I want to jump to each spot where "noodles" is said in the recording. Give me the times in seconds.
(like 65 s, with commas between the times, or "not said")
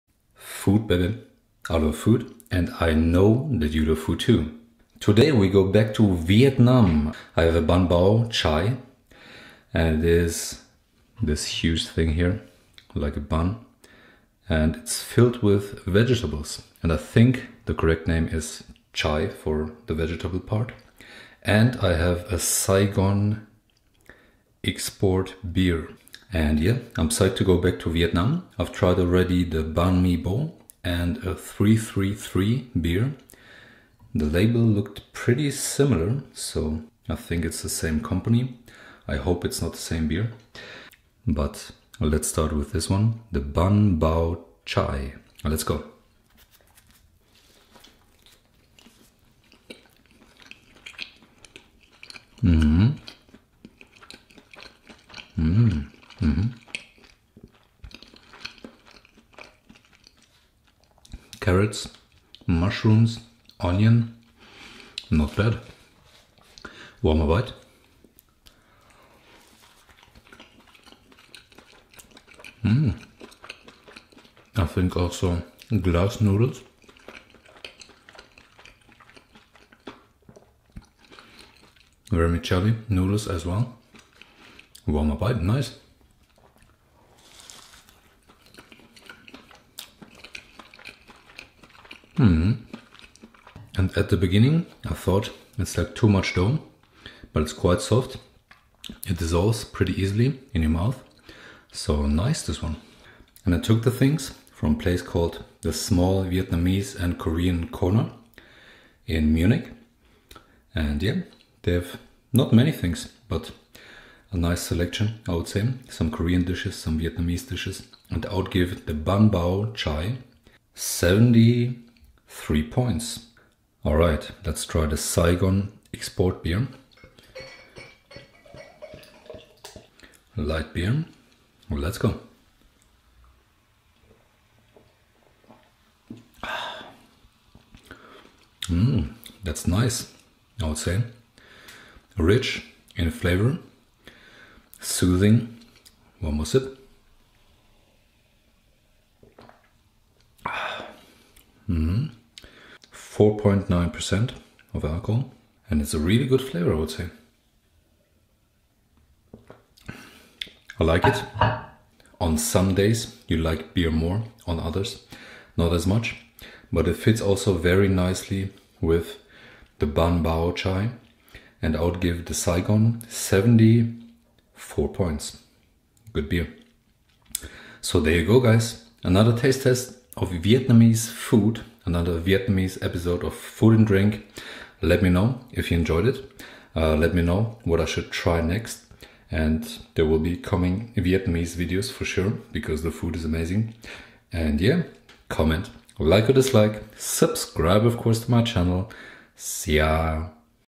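76 s, 82 s.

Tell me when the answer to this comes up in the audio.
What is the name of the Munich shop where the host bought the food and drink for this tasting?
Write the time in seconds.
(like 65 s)
105 s.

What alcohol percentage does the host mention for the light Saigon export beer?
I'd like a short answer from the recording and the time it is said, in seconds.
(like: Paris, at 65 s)
4.9%, at 153 s.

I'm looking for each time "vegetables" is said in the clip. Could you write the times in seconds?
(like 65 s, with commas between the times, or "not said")
15 s, 19 s.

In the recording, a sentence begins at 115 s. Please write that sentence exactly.
Some Korean dishes, some Vietnamese dishes.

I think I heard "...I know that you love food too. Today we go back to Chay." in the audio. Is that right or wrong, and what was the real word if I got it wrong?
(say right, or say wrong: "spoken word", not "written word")
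wrong: "Vietnam", not "Chay".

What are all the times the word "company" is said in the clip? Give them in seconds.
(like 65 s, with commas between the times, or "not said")
37 s.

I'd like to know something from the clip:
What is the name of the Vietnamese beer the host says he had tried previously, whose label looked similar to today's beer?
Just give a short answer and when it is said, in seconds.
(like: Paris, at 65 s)
333, at 31 s.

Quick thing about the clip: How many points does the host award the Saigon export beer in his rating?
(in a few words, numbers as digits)
74.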